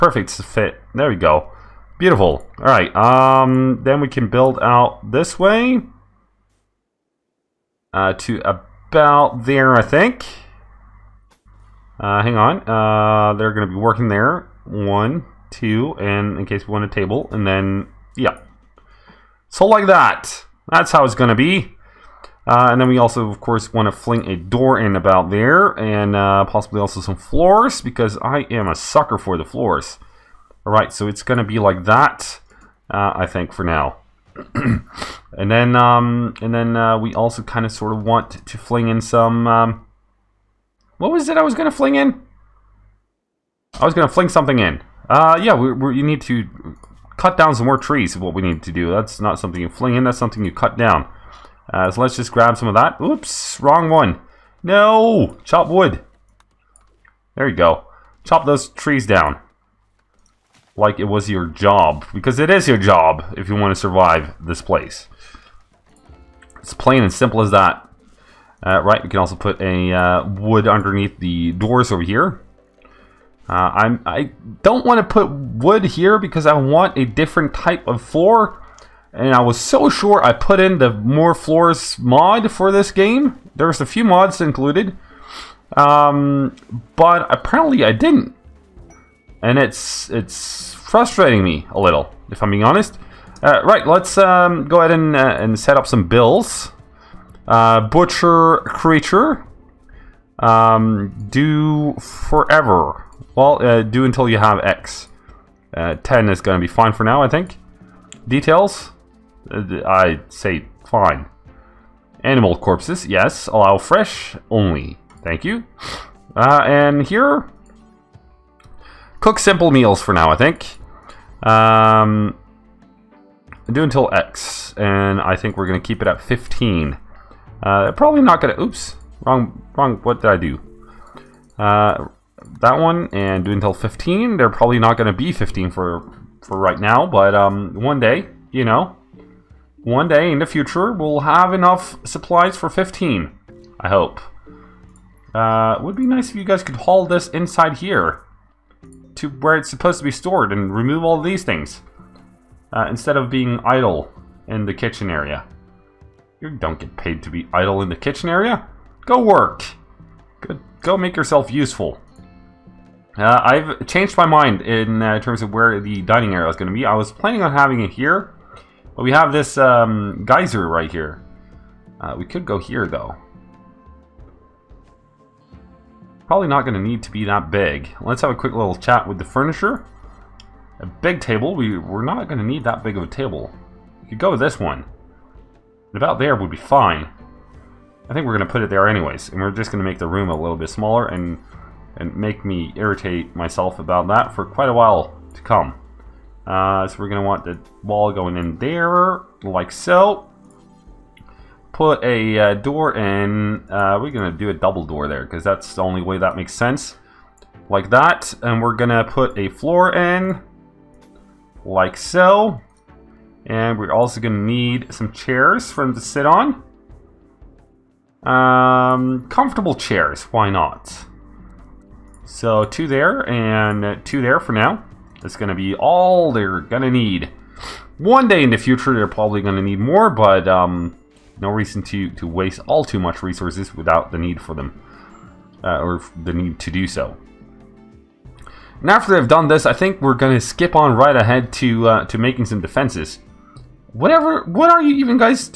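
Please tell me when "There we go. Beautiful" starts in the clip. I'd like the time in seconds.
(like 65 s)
0 s.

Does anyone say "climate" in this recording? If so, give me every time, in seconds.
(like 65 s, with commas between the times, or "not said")
not said.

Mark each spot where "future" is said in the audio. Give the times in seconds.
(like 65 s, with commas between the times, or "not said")
140 s, 228 s.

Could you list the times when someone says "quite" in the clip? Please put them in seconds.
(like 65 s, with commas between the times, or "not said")
194 s.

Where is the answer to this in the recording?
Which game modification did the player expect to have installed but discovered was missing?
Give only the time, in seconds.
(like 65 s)
80 s.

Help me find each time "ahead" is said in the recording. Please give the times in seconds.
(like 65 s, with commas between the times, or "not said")
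94 s, 241 s.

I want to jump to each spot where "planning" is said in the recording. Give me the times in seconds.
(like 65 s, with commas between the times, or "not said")
167 s.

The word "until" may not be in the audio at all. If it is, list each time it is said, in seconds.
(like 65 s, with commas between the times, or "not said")
104 s, 123 s, 133 s.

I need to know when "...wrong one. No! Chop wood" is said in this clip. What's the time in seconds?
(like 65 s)
53 s.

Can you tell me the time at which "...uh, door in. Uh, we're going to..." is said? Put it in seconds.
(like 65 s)
202 s.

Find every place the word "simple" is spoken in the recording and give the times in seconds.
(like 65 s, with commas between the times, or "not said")
67 s, 119 s.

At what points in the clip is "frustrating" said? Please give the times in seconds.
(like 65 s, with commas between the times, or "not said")
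90 s.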